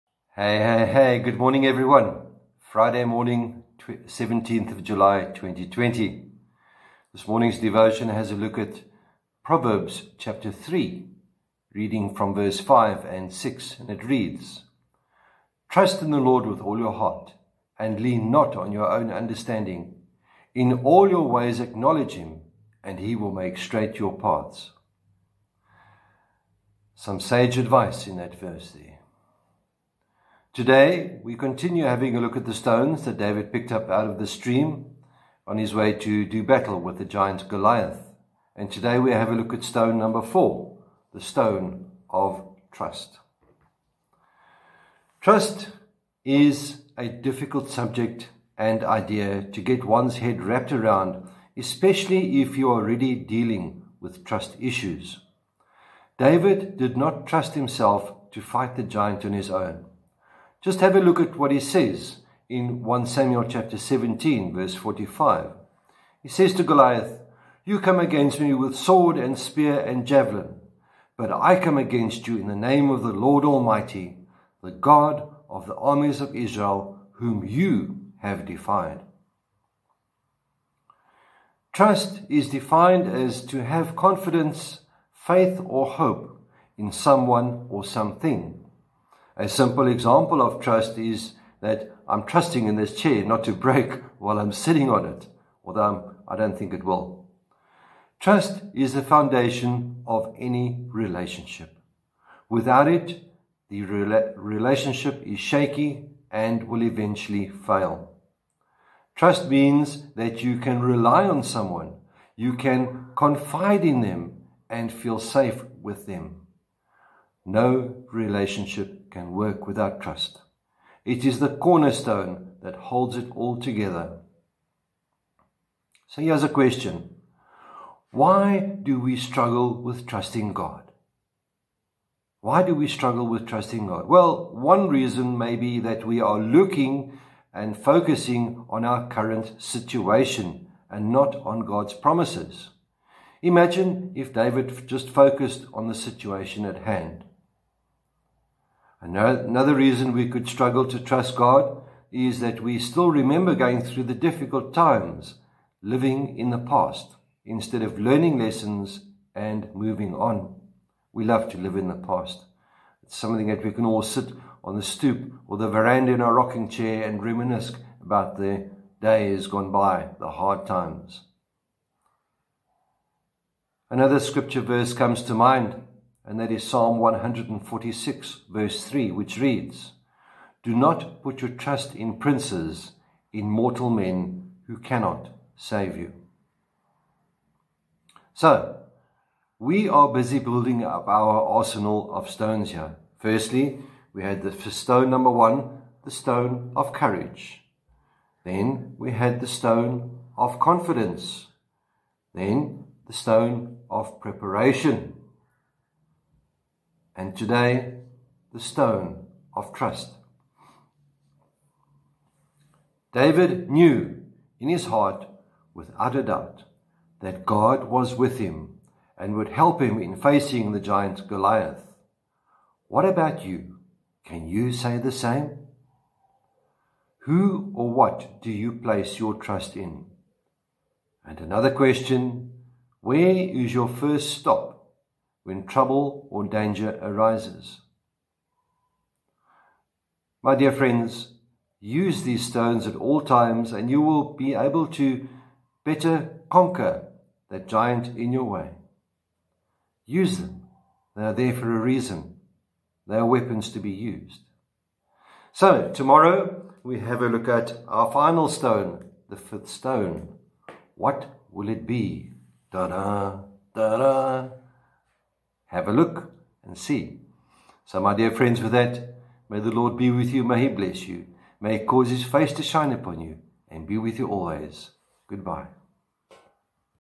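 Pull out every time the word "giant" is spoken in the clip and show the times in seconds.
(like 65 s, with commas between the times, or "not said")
37 s, 58 s, 220 s, 247 s.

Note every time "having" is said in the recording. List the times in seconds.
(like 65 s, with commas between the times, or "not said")
31 s.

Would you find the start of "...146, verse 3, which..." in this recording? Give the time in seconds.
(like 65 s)
176 s.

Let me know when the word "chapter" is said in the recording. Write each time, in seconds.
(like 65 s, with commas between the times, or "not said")
10 s, 63 s.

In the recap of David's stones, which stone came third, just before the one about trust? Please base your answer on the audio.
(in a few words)
Preparation.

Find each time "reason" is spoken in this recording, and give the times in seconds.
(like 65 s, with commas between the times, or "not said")
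134 s, 149 s, 251 s.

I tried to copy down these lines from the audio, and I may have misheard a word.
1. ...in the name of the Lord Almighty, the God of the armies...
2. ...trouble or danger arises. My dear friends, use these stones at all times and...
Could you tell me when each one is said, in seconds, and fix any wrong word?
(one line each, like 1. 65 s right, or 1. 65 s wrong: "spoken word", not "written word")
1. 72 s right
2. 235 s right.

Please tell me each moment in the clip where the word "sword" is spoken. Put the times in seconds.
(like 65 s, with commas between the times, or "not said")
68 s.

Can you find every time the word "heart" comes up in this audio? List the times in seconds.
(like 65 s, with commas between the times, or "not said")
16 s, 214 s.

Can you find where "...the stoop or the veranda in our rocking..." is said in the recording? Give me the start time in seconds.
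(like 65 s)
164 s.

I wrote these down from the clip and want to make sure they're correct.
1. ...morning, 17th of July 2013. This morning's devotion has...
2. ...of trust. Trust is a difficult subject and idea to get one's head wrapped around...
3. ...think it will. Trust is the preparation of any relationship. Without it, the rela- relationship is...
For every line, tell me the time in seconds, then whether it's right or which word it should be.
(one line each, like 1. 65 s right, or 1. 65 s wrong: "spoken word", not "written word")
1. 3 s wrong: "2020", not "2013"
2. 42 s right
3. 96 s wrong: "foundation", not "preparation".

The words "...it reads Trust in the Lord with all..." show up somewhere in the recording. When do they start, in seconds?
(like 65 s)
13 s.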